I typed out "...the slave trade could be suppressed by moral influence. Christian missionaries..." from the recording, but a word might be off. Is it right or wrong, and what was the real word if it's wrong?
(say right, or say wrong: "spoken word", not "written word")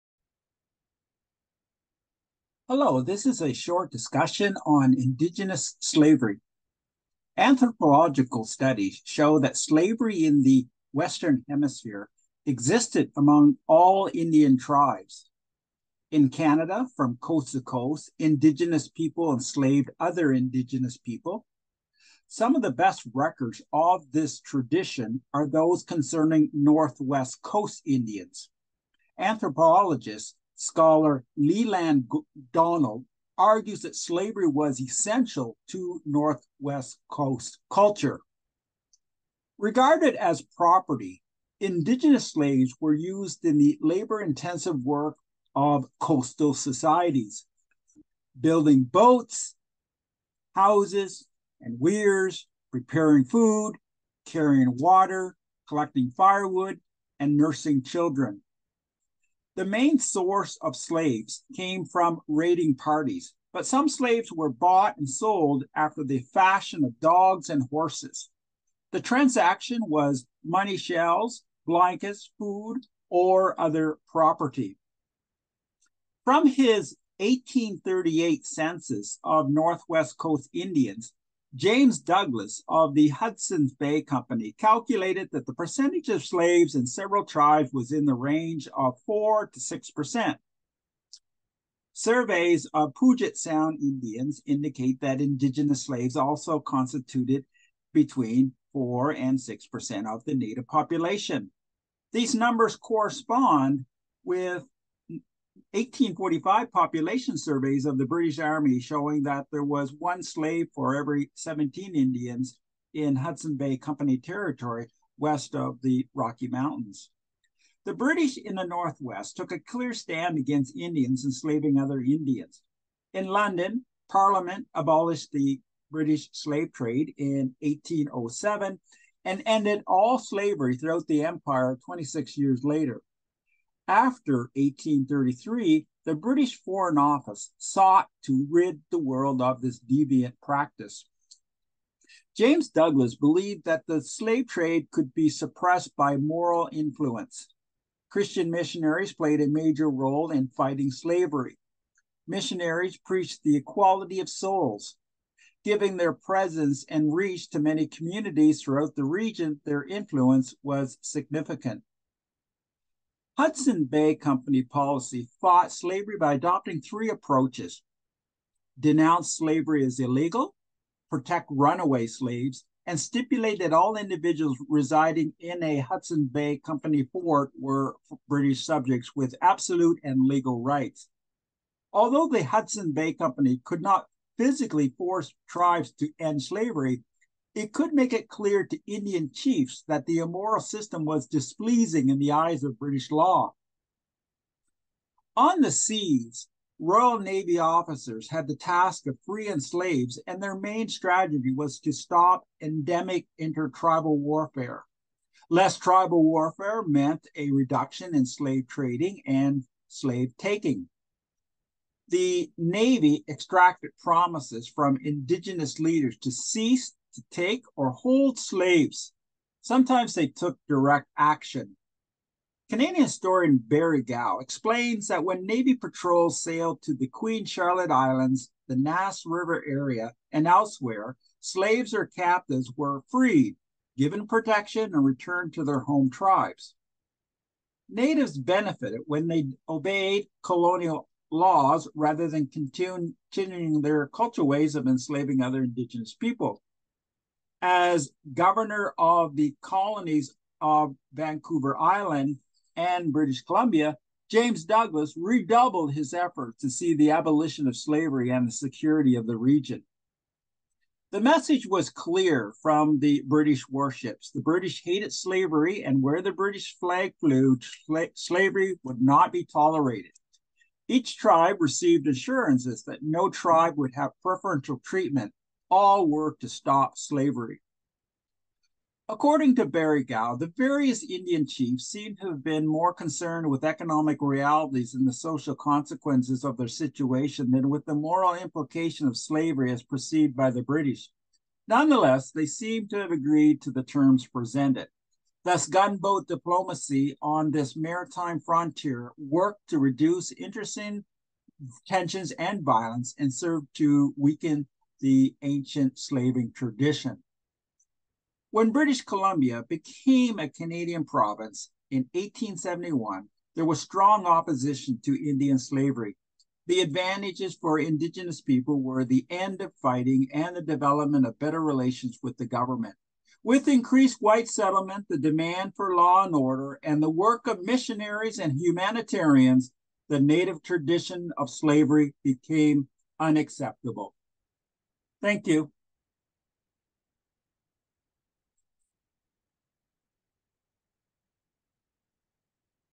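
right.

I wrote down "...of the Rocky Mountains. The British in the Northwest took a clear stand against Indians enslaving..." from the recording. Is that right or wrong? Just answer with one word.
right.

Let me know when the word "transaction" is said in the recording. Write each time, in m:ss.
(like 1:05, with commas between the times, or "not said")
1:09.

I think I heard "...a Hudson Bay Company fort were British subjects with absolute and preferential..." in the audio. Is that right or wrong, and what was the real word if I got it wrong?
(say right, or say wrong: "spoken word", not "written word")
wrong: "legal", not "preferential".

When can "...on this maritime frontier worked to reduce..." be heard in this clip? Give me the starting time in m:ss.
4:57.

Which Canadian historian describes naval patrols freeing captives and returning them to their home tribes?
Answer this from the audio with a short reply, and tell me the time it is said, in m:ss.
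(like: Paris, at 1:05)
Barry Gow, at 3:43.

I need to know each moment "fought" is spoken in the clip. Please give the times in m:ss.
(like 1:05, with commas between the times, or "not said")
2:45.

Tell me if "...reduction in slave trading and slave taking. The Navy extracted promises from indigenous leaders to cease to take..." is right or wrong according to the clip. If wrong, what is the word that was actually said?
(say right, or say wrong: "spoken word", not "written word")
right.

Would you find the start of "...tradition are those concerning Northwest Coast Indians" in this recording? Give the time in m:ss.
0:24.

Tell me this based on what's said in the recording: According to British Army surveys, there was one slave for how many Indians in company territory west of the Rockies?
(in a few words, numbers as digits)
17.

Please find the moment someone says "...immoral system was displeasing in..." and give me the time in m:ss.
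3:10.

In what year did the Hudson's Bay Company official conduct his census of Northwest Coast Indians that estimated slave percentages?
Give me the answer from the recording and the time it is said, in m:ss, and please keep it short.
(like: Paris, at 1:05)
1838, at 1:17.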